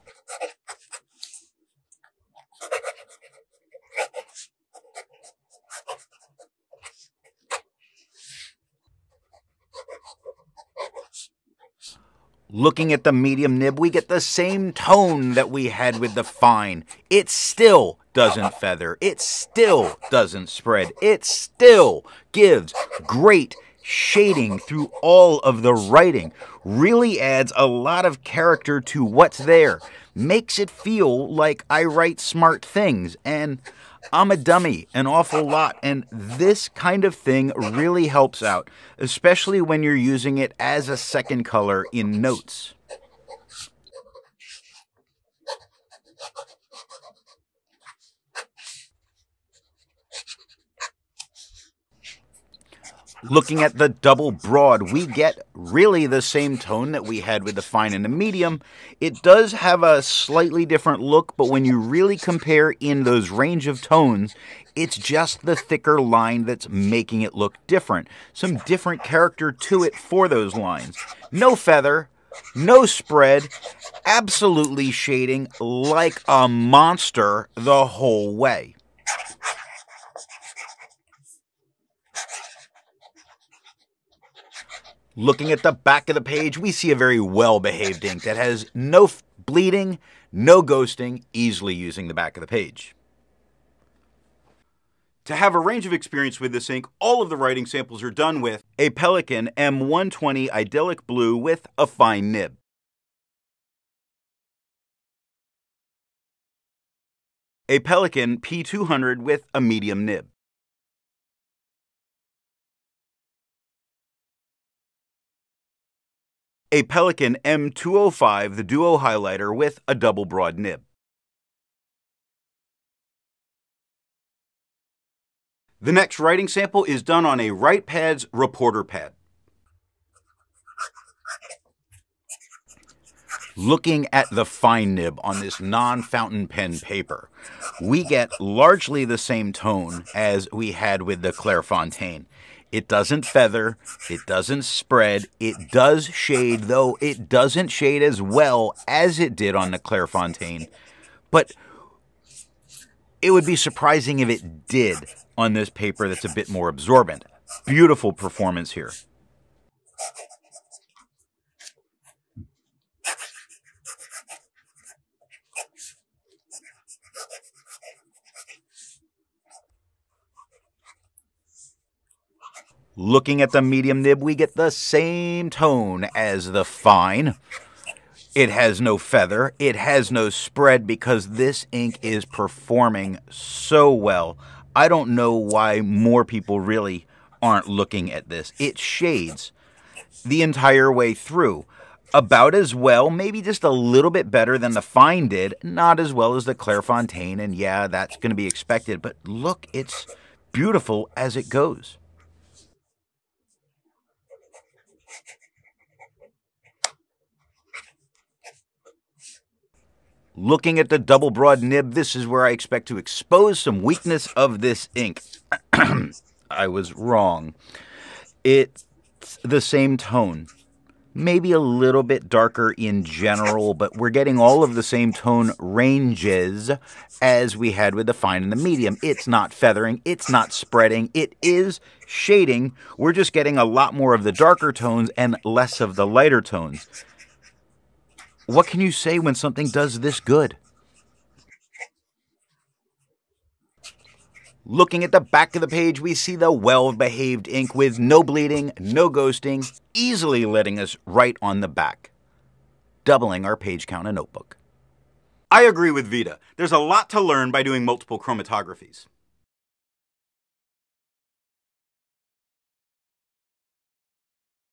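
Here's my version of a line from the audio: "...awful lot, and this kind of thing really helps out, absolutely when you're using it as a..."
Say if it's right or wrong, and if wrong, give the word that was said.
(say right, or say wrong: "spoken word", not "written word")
wrong: "especially", not "absolutely".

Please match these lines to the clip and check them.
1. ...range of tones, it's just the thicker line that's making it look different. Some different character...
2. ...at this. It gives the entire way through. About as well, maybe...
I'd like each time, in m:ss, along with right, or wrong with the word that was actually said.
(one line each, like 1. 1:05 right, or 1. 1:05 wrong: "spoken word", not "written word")
1. 1:03 right
2. 3:08 wrong: "shades", not "gives".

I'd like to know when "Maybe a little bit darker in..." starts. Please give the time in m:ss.
3:41.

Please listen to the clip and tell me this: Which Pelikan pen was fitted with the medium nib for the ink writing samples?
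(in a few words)
P200.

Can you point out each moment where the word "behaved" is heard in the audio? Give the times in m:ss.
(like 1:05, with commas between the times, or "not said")
1:27, 4:06.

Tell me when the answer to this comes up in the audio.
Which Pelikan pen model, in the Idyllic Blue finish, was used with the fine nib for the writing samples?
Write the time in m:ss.
1:38.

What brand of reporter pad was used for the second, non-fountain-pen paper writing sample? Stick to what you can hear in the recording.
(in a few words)
Writepads.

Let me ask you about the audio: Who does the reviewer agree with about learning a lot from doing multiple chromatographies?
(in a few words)
Vita.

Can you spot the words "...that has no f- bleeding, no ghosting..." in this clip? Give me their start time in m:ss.
1:28.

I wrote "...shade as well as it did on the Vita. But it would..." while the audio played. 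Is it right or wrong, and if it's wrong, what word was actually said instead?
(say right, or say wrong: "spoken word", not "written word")
wrong: "Clairefontaine", not "Vita".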